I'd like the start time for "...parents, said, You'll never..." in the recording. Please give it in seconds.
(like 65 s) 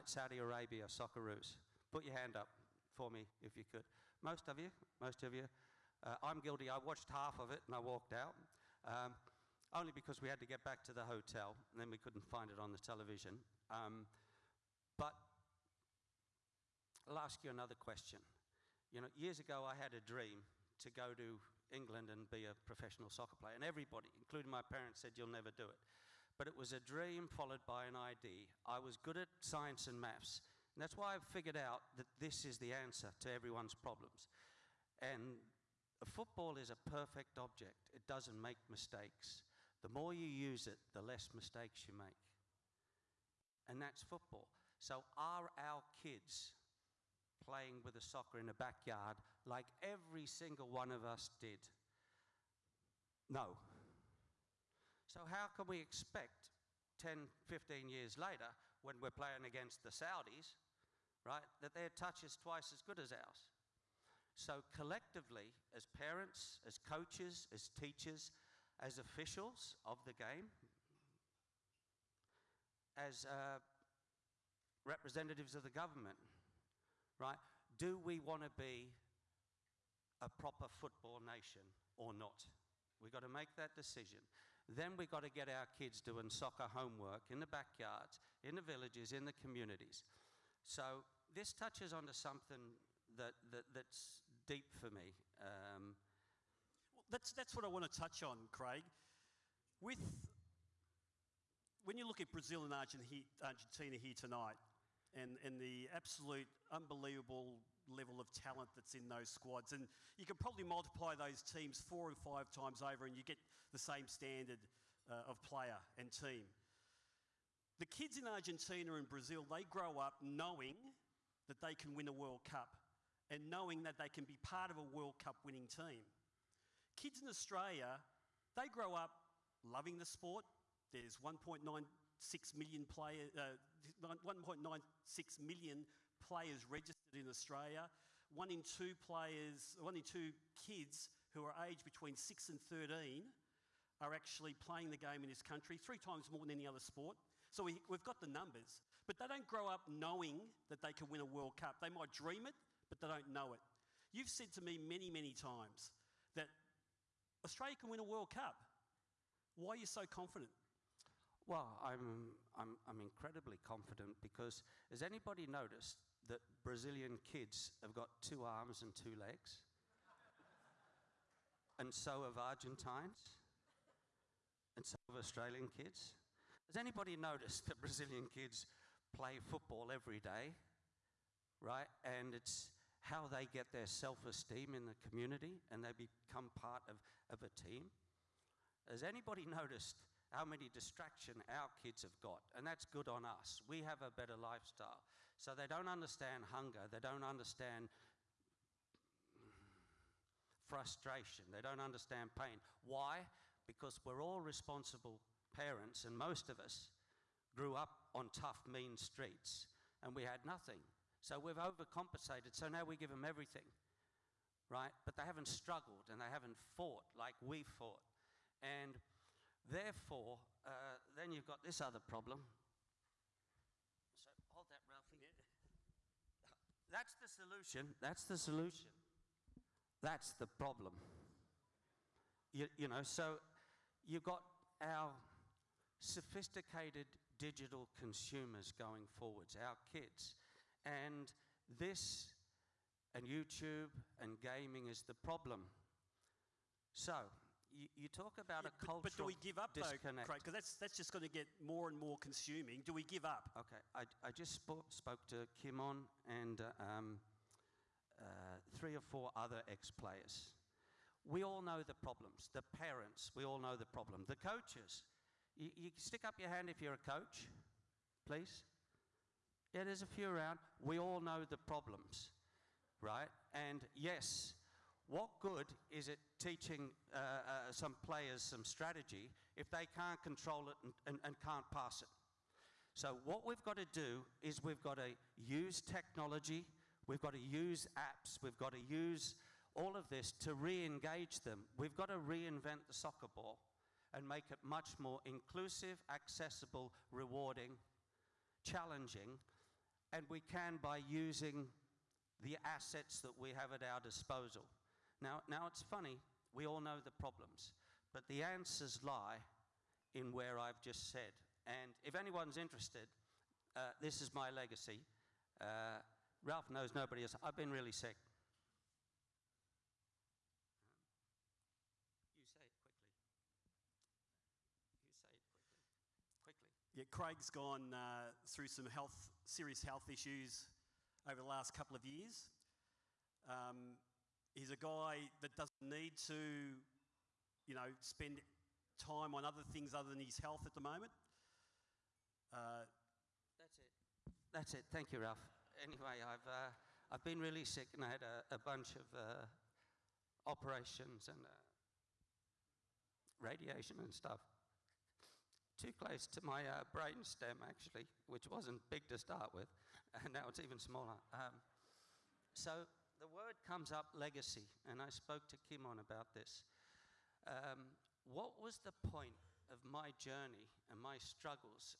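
24 s.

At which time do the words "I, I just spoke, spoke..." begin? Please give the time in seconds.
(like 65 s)
253 s.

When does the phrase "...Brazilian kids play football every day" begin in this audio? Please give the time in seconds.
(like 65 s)
177 s.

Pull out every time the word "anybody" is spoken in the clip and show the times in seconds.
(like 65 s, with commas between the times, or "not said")
165 s, 176 s, 189 s.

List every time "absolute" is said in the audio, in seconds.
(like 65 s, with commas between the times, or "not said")
105 s.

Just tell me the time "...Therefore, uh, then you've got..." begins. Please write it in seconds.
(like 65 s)
219 s.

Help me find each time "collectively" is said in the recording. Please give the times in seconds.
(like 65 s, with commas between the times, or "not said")
64 s.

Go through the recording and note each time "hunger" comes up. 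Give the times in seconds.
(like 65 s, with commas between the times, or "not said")
196 s.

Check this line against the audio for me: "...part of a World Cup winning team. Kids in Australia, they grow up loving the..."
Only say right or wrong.
right.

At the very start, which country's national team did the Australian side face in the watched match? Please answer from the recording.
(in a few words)
Saudi Arabia.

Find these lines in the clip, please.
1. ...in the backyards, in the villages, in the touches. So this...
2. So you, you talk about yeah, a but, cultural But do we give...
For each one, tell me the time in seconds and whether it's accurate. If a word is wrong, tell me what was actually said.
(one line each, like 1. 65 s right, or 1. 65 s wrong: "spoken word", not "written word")
1. 87 s wrong: "communities", not "touches"
2. 246 s right.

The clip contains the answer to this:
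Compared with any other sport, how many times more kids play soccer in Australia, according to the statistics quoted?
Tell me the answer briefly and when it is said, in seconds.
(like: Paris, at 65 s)
3 times, at 145 s.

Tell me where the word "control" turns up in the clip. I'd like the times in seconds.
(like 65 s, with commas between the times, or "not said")
280 s.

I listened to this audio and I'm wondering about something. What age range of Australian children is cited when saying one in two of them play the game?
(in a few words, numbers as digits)
6 to 13.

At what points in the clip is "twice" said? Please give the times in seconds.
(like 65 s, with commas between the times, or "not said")
62 s.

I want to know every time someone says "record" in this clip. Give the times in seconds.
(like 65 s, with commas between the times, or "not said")
not said.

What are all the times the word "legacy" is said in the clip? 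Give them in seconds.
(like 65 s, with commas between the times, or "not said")
314 s, 364 s.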